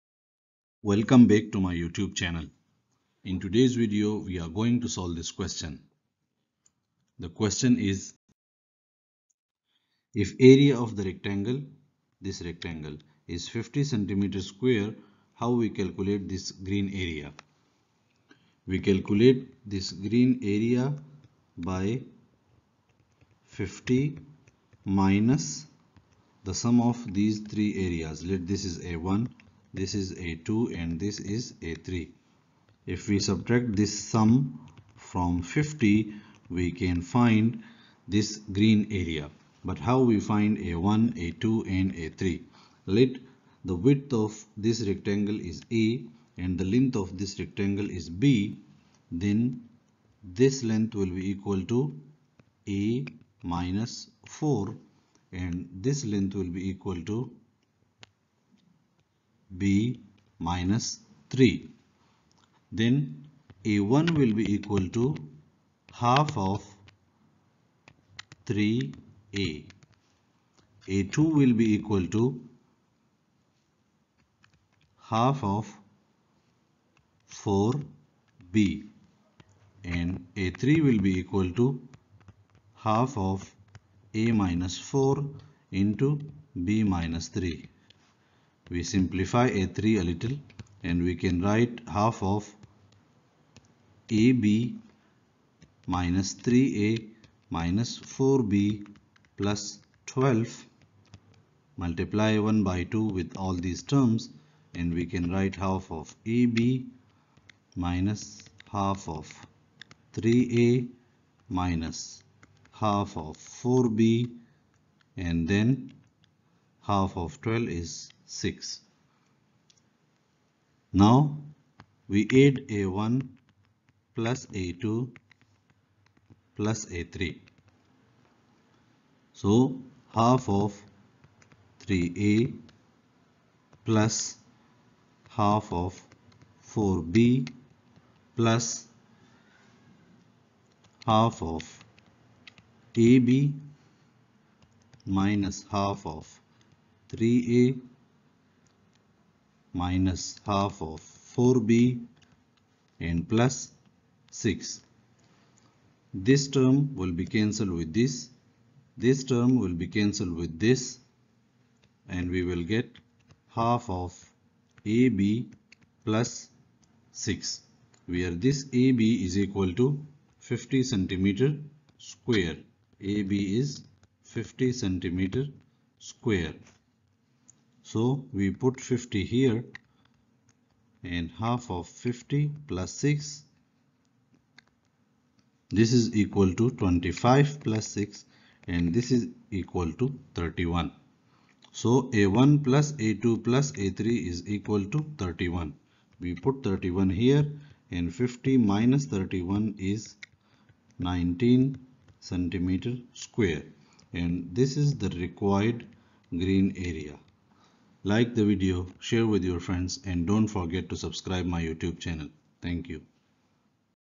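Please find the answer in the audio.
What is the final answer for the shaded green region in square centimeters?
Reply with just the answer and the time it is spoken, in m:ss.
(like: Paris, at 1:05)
19, at 3:20.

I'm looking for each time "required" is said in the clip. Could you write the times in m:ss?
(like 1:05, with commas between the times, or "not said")
3:25.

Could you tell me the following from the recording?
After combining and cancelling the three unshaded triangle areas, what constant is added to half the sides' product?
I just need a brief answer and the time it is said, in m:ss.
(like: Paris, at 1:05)
6, at 1:56.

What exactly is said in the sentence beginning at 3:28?
Like the video, share with your friends and don't forget to subscribe my YouTube channel.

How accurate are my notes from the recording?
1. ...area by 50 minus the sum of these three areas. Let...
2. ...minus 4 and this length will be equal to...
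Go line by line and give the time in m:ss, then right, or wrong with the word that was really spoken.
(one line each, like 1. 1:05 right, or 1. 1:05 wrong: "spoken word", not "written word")
1. 0:20 right
2. 0:53 right.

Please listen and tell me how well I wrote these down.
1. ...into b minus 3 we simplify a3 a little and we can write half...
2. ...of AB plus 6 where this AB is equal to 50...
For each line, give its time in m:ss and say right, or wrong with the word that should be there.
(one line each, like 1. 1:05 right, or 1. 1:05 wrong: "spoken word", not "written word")
1. 1:25 right
2. 2:43 right.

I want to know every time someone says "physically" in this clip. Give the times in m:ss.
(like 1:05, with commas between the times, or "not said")
not said.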